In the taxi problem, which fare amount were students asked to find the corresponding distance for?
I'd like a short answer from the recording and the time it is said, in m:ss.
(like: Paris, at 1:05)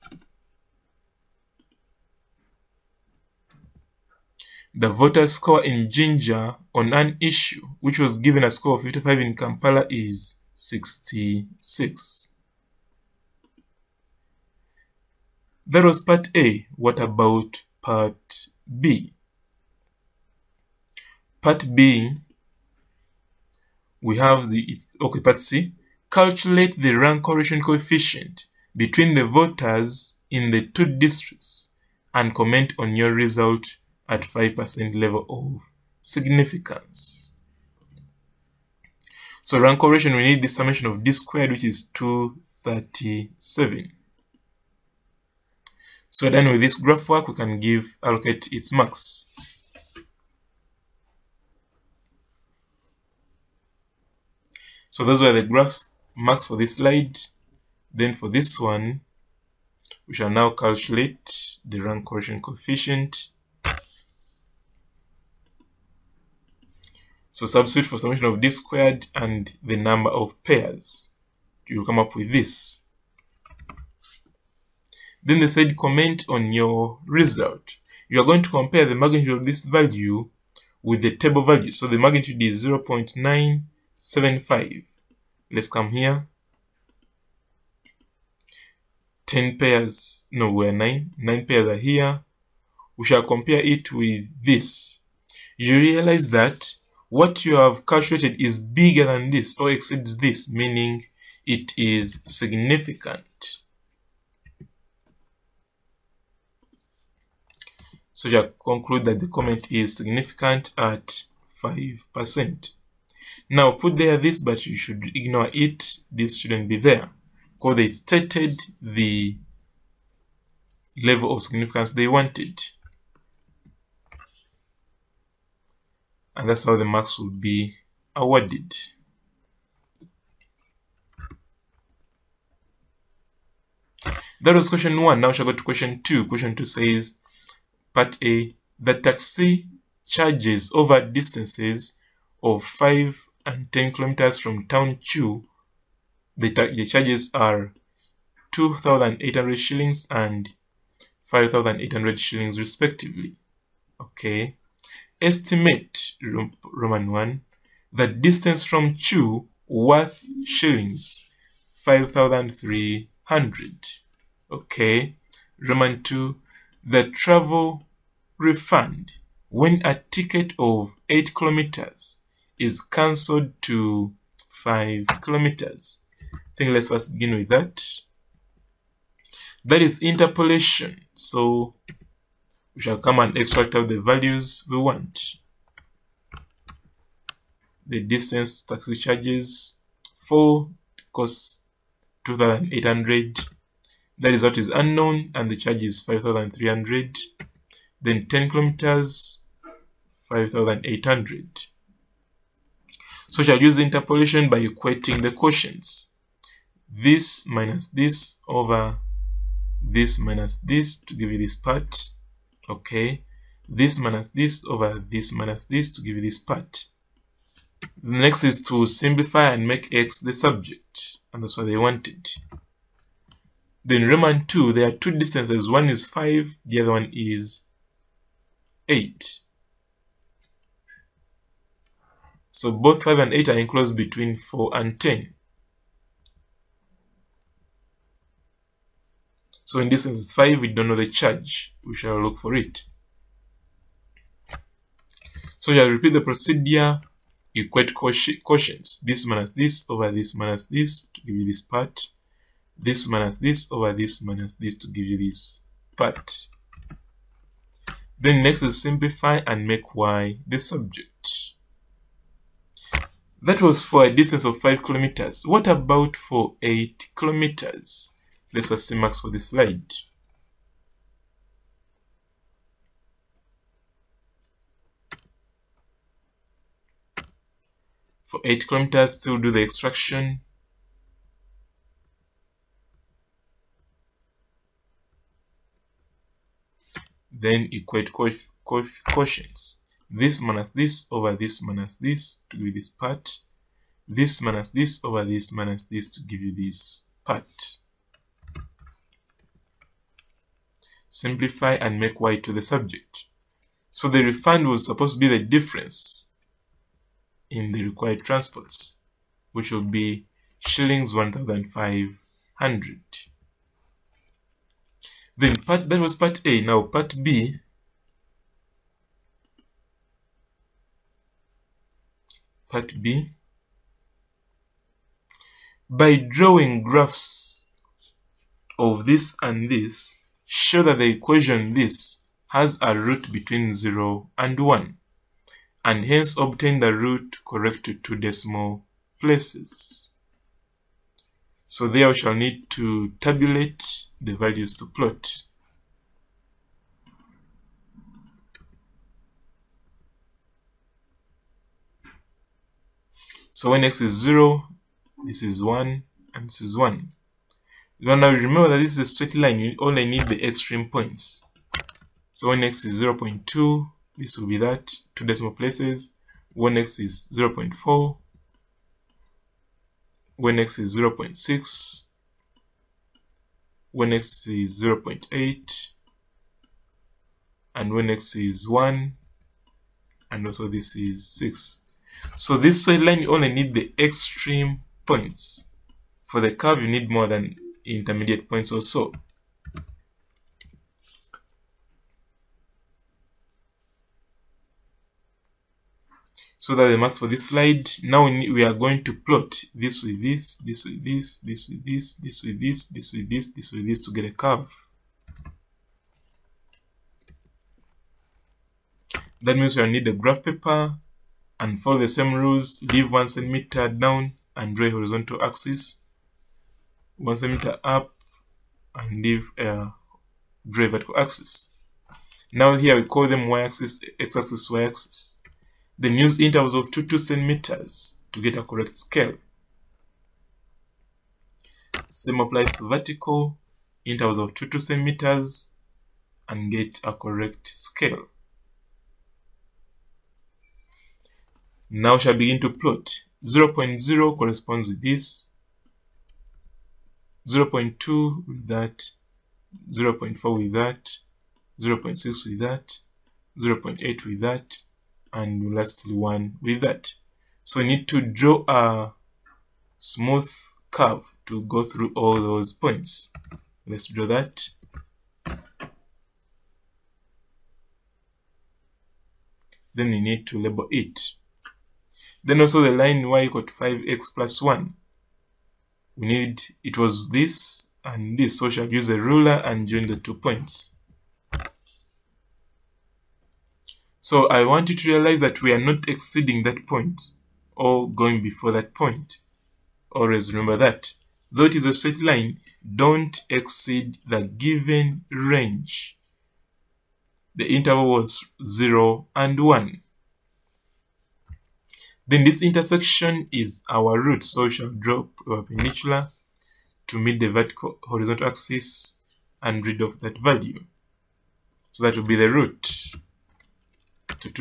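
5,300 shillings, at 2:40.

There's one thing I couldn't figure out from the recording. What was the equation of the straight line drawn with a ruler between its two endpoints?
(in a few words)
y = 5x + 1.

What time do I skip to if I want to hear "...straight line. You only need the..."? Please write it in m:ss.
5:59.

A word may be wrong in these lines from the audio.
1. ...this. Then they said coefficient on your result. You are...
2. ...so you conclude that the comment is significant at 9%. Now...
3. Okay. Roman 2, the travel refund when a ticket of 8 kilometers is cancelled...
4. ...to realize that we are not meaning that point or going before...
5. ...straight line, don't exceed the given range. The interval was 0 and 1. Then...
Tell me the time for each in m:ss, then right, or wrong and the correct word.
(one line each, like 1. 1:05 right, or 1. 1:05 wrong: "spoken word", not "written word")
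1. 1:12 wrong: "comment", not "coefficient"
2. 1:48 wrong: "5", not "9"
3. 2:44 right
4. 8:04 wrong: "exceeding", not "meaning"
5. 8:11 right.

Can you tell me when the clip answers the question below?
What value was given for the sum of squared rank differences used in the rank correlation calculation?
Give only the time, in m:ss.
0:41.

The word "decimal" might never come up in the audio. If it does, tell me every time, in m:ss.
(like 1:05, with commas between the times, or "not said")
5:38, 6:05.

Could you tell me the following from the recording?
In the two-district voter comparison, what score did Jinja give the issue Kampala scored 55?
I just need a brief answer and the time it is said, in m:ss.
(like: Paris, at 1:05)
66, at 0:10.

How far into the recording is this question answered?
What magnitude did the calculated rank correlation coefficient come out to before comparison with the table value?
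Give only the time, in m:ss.
1:22.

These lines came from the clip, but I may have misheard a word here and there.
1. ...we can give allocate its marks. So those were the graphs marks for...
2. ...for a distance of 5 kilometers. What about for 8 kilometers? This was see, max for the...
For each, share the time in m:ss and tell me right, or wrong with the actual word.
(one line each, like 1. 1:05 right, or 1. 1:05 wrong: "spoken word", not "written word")
1. 0:47 right
2. 4:23 right.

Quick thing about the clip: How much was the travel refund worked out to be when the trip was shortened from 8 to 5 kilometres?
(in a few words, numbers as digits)
1,500 shillings.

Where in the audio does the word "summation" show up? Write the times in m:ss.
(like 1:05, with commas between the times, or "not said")
0:40, 1:07.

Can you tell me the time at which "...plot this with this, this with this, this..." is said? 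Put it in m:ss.
6:39.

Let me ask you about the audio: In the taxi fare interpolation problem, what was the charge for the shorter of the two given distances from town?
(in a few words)
2,800 shillings.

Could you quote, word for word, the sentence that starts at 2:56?
I think let's first begin with that.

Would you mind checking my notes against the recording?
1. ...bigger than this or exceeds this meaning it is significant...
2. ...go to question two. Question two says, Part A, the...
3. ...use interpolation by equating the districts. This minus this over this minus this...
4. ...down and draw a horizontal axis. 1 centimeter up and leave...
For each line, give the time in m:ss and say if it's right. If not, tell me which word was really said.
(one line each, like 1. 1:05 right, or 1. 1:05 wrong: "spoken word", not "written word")
1. 1:38 right
2. 2:15 right
3. 3:23 wrong: "quotients", not "districts"
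4. 6:53 right.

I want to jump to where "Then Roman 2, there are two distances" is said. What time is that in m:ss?
3:43.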